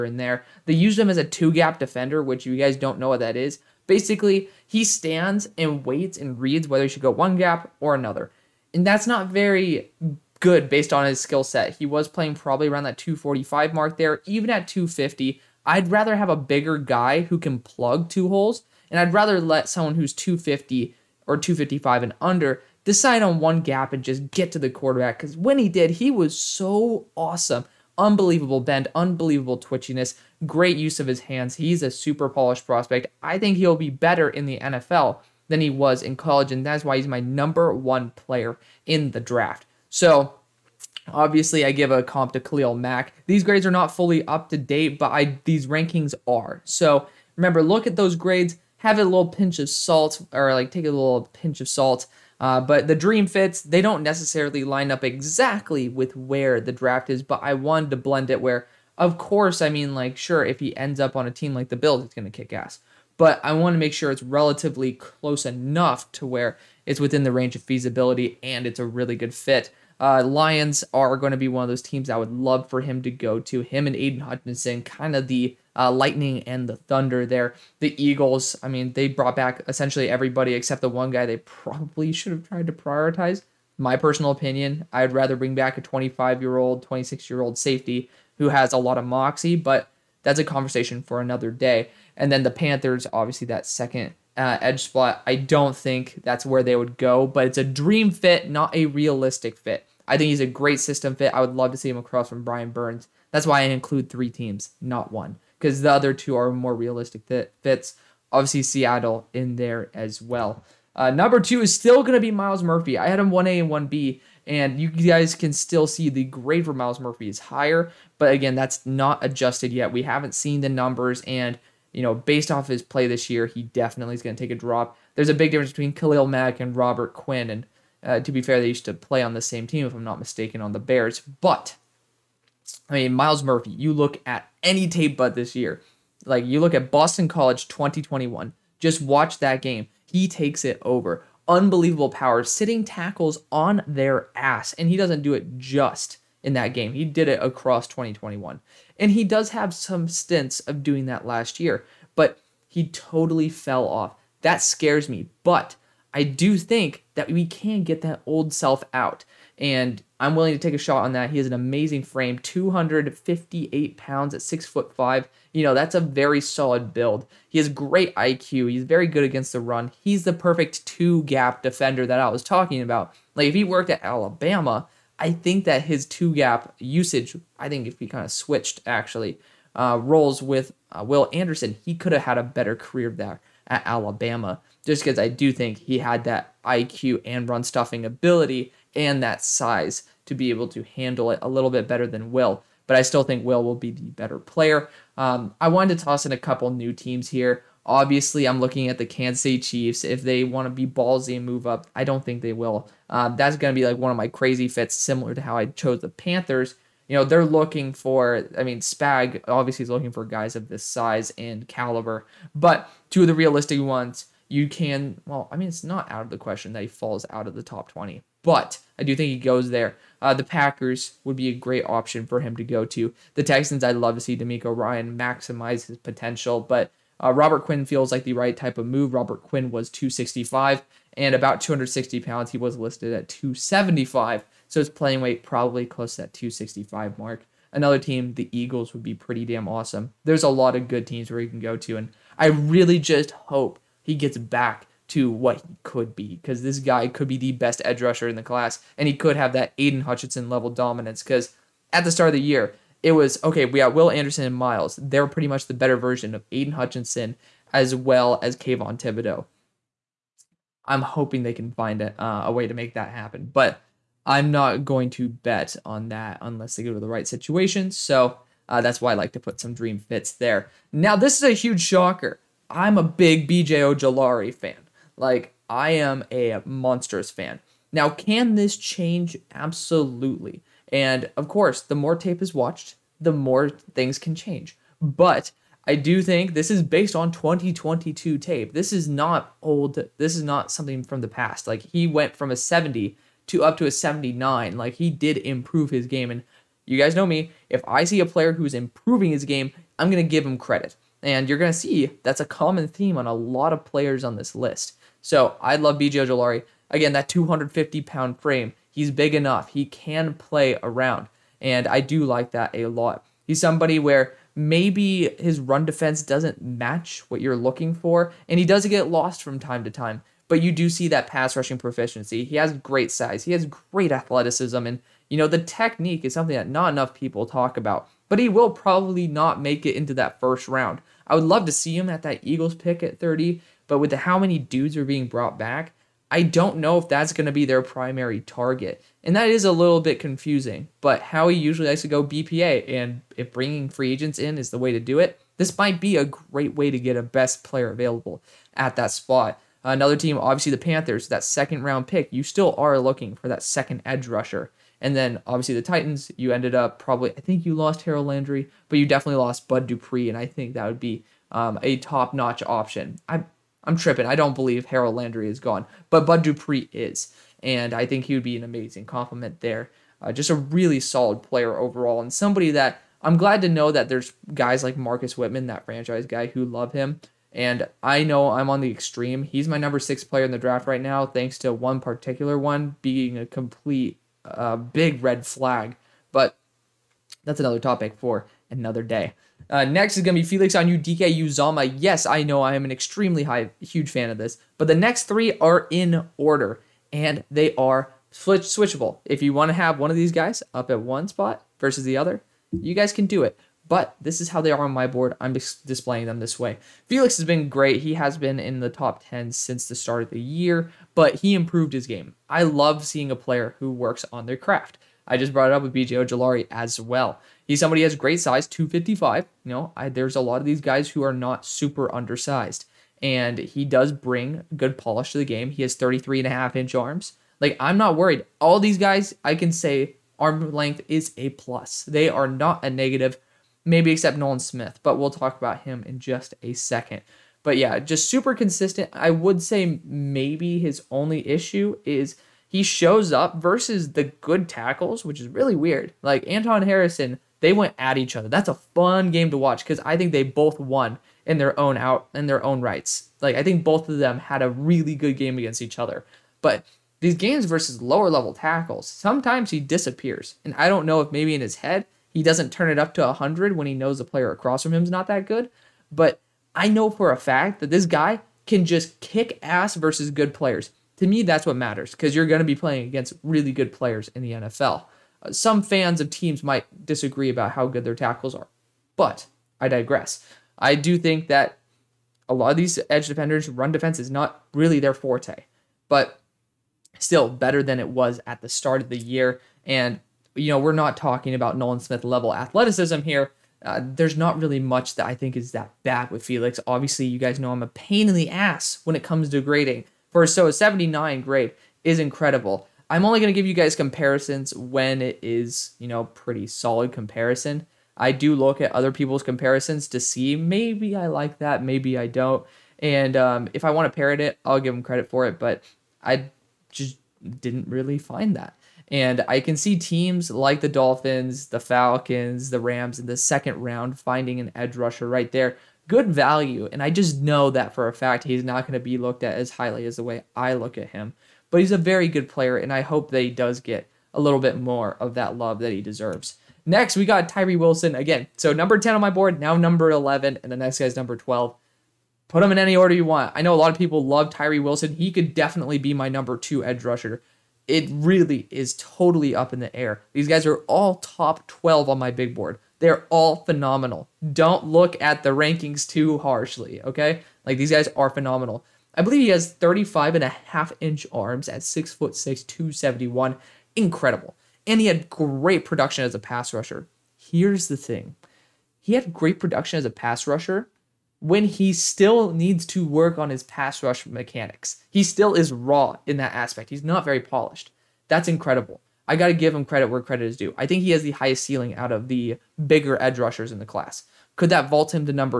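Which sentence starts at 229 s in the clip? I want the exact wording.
Robert Quinn was 265 and about 260 pounds.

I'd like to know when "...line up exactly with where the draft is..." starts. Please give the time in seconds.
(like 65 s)
54 s.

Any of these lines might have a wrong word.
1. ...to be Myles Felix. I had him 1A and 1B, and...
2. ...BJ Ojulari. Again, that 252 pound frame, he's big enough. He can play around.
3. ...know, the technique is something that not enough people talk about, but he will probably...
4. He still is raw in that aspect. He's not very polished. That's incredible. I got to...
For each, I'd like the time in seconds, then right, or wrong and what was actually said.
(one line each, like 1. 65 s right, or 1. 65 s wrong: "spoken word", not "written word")
1. 112 s wrong: "Murphy", not "Felix"
2. 305 s wrong: "250", not "252"
3. 325 s right
4. 575 s right.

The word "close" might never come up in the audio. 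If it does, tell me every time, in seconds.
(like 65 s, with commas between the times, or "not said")
64 s, 235 s.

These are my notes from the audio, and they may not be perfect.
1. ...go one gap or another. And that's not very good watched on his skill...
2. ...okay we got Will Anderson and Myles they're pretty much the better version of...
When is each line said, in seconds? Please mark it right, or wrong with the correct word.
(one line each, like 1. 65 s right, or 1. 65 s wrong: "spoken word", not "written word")
1. 7 s wrong: "based", not "watched"
2. 253 s right.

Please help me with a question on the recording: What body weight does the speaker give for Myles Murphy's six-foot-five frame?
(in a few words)
258 pounds.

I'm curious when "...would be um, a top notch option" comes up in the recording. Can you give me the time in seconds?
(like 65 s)
360 s.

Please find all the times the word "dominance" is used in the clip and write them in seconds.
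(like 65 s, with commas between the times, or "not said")
250 s.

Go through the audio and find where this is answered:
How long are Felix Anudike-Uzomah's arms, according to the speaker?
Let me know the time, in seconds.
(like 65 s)
425 s.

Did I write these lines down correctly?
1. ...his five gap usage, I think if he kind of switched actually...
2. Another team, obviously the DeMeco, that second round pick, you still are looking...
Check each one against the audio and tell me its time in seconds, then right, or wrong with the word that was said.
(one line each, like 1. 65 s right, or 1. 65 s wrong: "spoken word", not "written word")
1. 175 s wrong: "two", not "five"
2. 349 s wrong: "Panthers", not "DeMeco".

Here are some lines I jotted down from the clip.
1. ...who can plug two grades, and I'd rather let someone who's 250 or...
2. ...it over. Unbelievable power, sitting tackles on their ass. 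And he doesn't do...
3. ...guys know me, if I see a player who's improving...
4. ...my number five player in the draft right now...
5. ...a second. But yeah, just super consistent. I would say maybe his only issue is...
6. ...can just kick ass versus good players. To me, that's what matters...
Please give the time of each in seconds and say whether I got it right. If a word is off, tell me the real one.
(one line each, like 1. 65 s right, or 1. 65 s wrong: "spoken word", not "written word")
1. 17 s wrong: "holes", not "grades"
2. 140 s right
3. 296 s right
4. 379 s wrong: "six", not "five"
5. 436 s right
6. 468 s right.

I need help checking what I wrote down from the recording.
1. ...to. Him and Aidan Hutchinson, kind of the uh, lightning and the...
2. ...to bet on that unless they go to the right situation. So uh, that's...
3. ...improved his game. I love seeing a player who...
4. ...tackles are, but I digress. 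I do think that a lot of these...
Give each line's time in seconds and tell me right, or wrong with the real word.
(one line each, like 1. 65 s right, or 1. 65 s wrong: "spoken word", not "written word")
1. 73 s right
2. 265 s right
3. 411 s right
4. 478 s right.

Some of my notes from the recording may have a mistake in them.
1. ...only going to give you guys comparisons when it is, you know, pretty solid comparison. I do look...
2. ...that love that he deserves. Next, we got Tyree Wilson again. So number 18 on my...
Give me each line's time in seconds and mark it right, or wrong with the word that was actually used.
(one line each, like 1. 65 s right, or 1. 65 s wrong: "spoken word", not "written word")
1. 503 s right
2. 535 s wrong: "10", not "18".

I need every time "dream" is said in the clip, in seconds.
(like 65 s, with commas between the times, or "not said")
52 s, 97 s, 269 s.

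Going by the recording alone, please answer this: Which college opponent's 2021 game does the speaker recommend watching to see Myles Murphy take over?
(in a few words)
Boston College.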